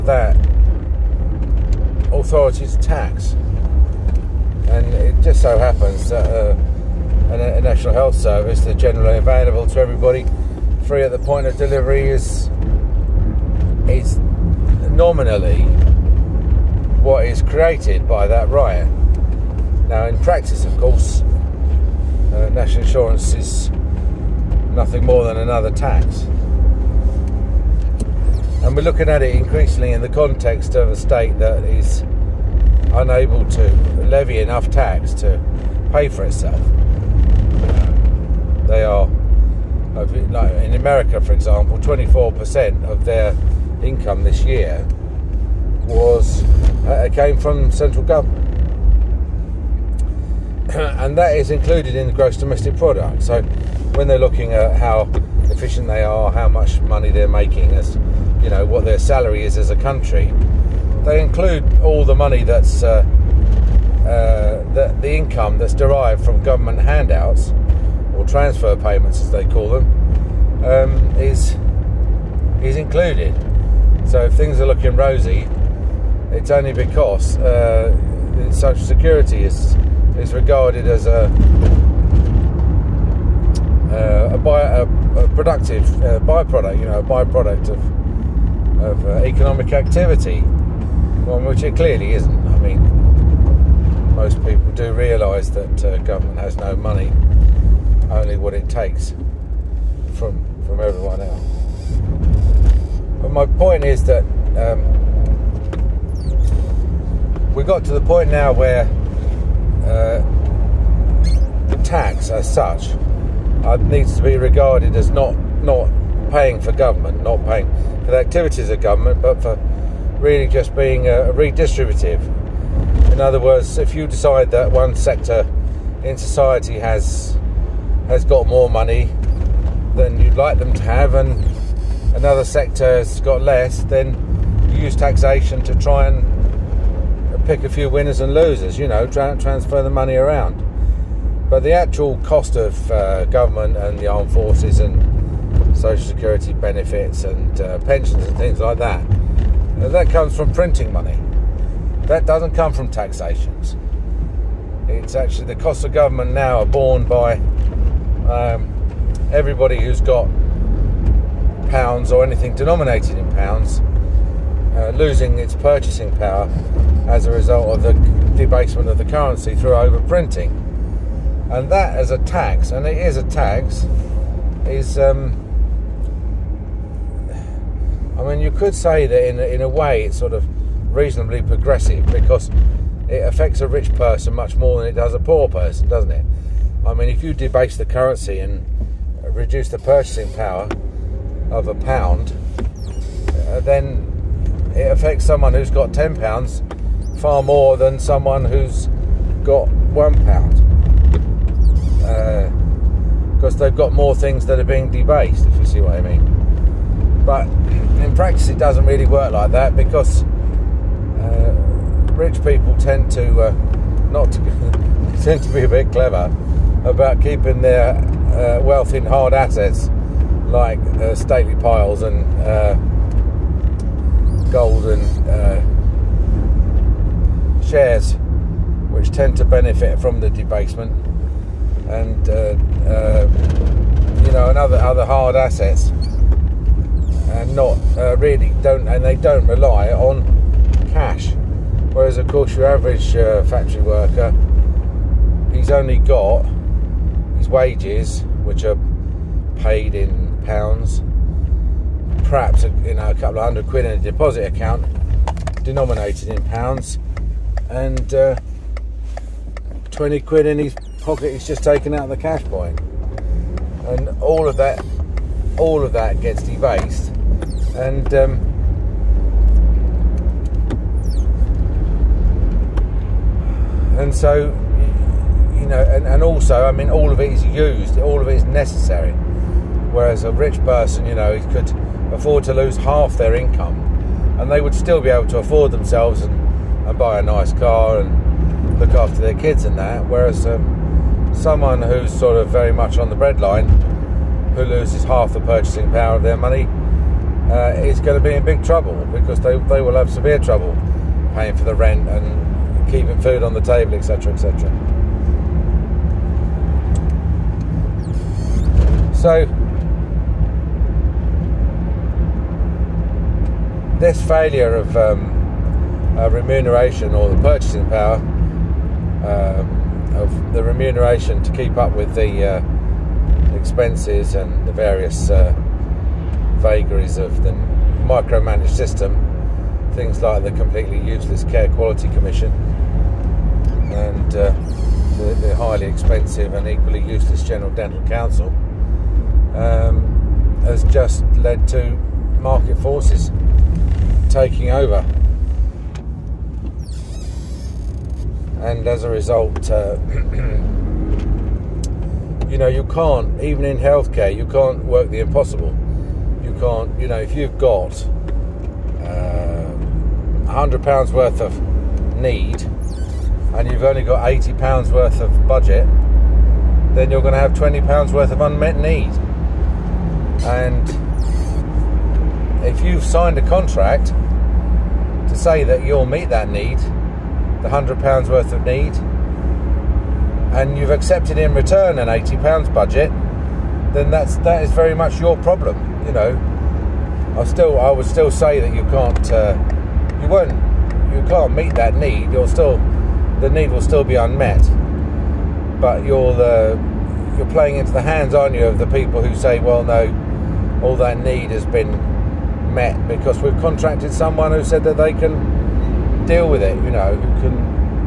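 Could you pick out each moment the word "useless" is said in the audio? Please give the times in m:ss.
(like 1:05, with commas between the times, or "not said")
5:30, 5:37.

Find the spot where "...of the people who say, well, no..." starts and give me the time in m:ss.
6:38.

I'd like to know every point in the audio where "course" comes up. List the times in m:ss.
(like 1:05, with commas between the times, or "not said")
0:20, 4:02.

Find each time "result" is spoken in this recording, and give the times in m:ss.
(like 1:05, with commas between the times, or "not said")
2:47, 5:49.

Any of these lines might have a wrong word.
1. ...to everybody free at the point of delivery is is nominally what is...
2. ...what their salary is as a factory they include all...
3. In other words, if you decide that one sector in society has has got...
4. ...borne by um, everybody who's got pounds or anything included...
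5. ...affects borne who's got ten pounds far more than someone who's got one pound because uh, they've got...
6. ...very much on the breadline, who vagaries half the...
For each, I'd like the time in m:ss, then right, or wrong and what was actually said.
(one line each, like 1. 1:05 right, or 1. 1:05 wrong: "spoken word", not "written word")
1. 0:09 right
2. 0:58 wrong: "country", not "factory"
3. 2:03 right
4. 2:36 wrong: "denominated", not "included"
5. 3:14 wrong: "someone", not "borne"
6. 4:52 wrong: "loses", not "vagaries".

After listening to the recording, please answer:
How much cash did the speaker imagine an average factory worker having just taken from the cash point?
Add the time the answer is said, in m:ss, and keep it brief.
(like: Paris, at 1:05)
£20, at 4:19.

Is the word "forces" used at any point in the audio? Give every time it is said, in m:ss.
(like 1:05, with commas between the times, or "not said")
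2:24, 5:42.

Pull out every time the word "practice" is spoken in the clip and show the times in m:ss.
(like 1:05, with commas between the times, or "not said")
0:20, 3:28.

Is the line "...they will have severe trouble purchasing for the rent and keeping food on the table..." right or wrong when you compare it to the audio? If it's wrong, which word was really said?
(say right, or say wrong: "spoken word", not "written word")
wrong: "paying", not "purchasing".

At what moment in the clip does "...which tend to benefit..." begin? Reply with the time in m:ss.
3:48.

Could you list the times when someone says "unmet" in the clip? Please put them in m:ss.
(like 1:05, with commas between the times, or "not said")
6:08, 6:34.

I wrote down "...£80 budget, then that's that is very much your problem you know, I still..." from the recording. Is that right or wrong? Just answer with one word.
right.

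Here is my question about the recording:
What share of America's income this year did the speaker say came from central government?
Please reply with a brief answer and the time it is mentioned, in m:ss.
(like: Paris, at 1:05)
24%, at 0:41.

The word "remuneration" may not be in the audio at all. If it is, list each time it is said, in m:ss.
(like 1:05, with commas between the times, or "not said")
5:16, 5:20.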